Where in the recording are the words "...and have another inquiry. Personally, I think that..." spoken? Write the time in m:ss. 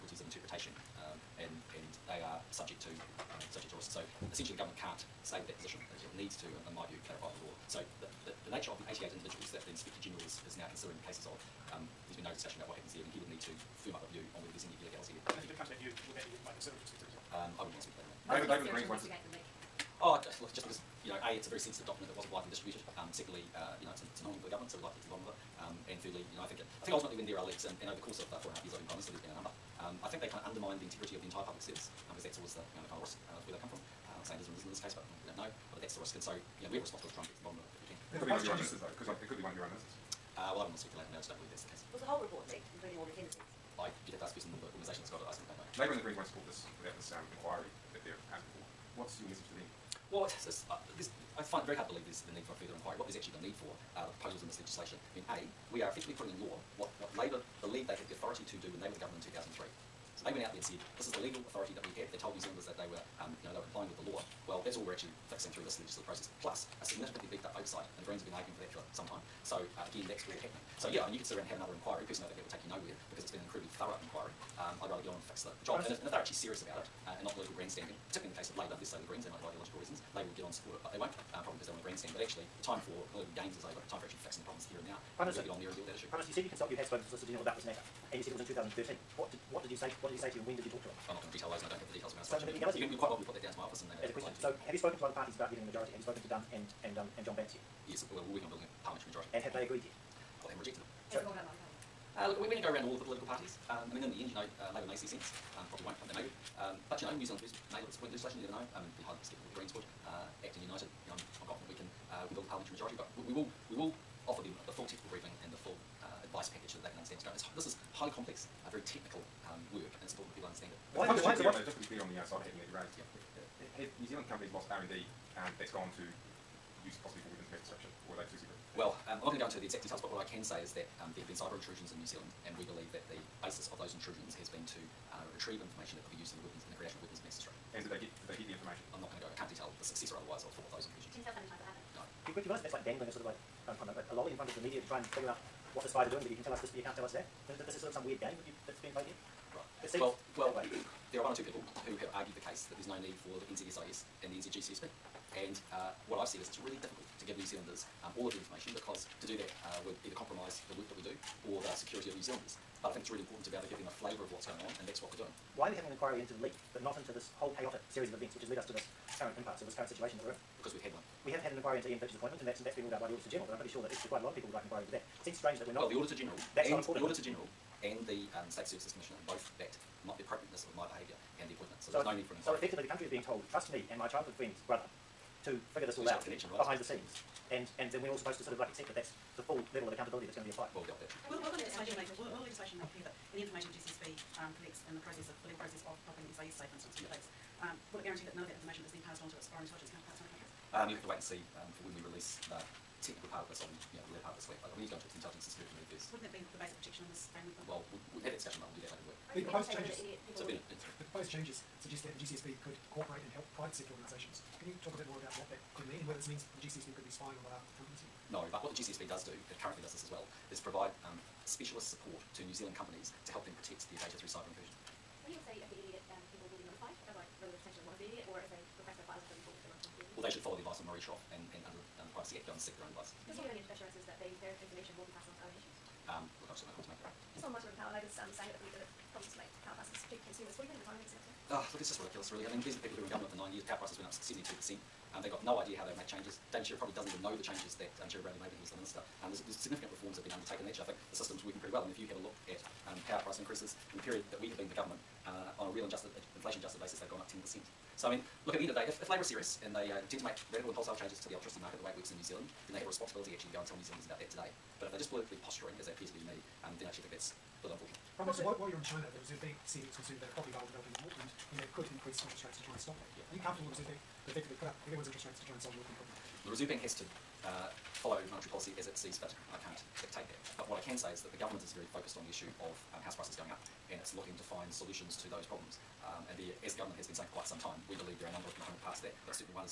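1:11.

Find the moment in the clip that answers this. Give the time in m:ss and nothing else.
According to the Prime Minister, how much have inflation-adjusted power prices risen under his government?
4:17.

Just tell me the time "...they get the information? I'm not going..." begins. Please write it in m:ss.
2:18.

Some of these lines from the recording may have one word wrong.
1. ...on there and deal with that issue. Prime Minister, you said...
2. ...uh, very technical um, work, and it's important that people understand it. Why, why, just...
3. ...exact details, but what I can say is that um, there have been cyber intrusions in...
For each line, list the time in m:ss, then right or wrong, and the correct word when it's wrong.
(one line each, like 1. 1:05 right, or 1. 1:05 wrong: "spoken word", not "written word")
1. 1:25 right
2. 1:58 right
3. 2:09 right.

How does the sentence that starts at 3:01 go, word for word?
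So, so there's no need for an inquiry.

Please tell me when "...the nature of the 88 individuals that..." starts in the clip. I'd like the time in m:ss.
0:08.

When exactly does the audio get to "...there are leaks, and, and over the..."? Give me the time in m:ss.
0:27.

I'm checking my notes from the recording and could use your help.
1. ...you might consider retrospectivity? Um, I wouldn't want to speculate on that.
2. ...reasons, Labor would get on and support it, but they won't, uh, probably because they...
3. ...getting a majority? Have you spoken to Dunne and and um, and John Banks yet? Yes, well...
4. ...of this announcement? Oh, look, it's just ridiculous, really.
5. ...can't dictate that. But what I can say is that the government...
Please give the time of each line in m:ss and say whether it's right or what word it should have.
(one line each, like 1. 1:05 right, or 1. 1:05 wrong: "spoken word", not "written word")
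1. 0:16 right
2. 1:19 right
3. 1:35 right
4. 4:01 right
5. 4:39 right.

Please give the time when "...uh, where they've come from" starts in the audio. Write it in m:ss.
0:33.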